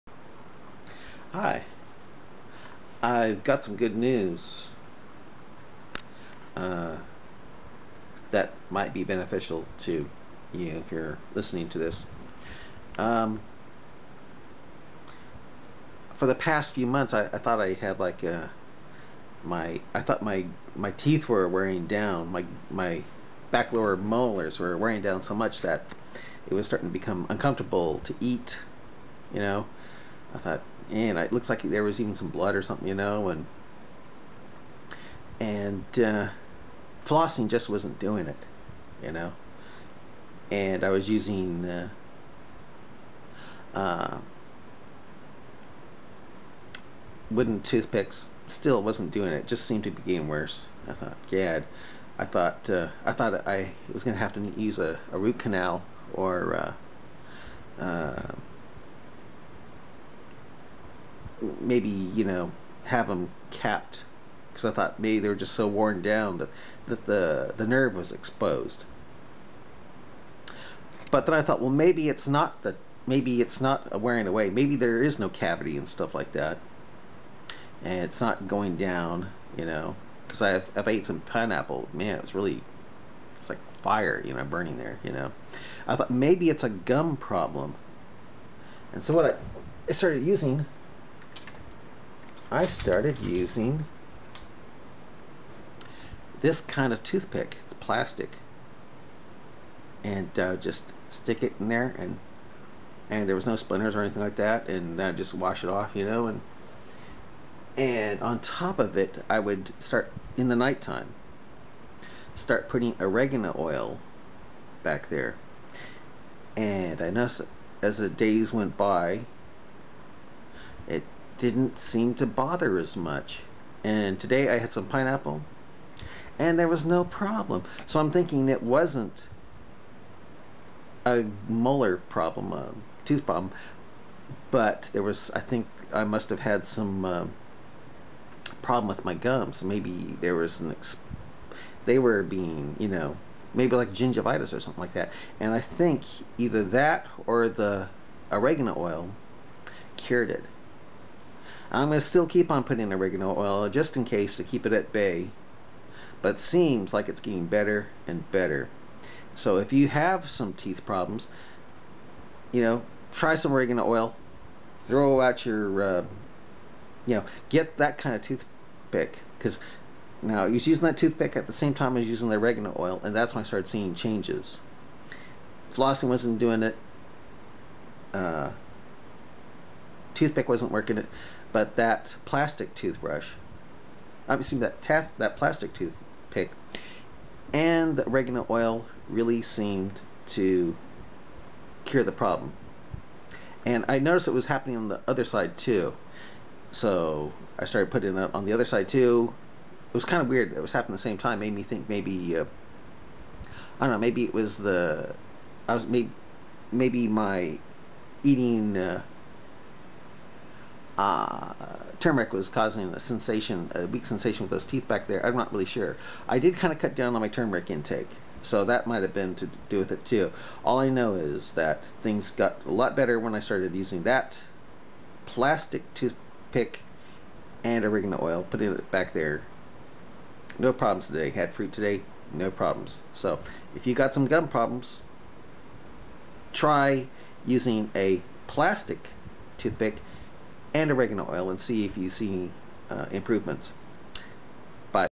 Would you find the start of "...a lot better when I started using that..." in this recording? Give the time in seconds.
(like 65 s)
222 s.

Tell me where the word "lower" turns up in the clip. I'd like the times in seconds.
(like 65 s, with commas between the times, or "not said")
23 s.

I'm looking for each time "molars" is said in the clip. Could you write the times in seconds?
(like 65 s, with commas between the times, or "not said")
23 s, 131 s.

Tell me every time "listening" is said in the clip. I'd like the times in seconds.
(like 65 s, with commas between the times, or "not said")
11 s.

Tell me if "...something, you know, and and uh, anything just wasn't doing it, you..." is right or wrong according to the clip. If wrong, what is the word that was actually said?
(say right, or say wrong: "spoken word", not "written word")
wrong: "flossing", not "anything".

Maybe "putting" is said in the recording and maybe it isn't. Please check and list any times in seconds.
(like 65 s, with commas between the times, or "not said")
112 s, 152 s, 197 s, 228 s.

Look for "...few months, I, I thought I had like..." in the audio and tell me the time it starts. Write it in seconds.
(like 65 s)
16 s.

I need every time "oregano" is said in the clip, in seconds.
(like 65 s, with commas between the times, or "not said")
112 s, 148 s, 152 s, 163 s, 172 s, 188 s, 227 s, 240 s.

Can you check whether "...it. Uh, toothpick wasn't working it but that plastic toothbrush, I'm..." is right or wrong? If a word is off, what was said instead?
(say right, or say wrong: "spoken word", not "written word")
right.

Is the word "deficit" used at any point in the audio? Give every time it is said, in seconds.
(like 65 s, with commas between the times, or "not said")
not said.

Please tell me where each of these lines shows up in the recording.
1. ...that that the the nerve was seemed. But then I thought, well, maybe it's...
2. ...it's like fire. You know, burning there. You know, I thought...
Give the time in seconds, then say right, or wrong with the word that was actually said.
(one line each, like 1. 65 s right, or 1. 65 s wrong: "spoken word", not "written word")
1. 66 s wrong: "exposed", not "seemed"
2. 83 s right.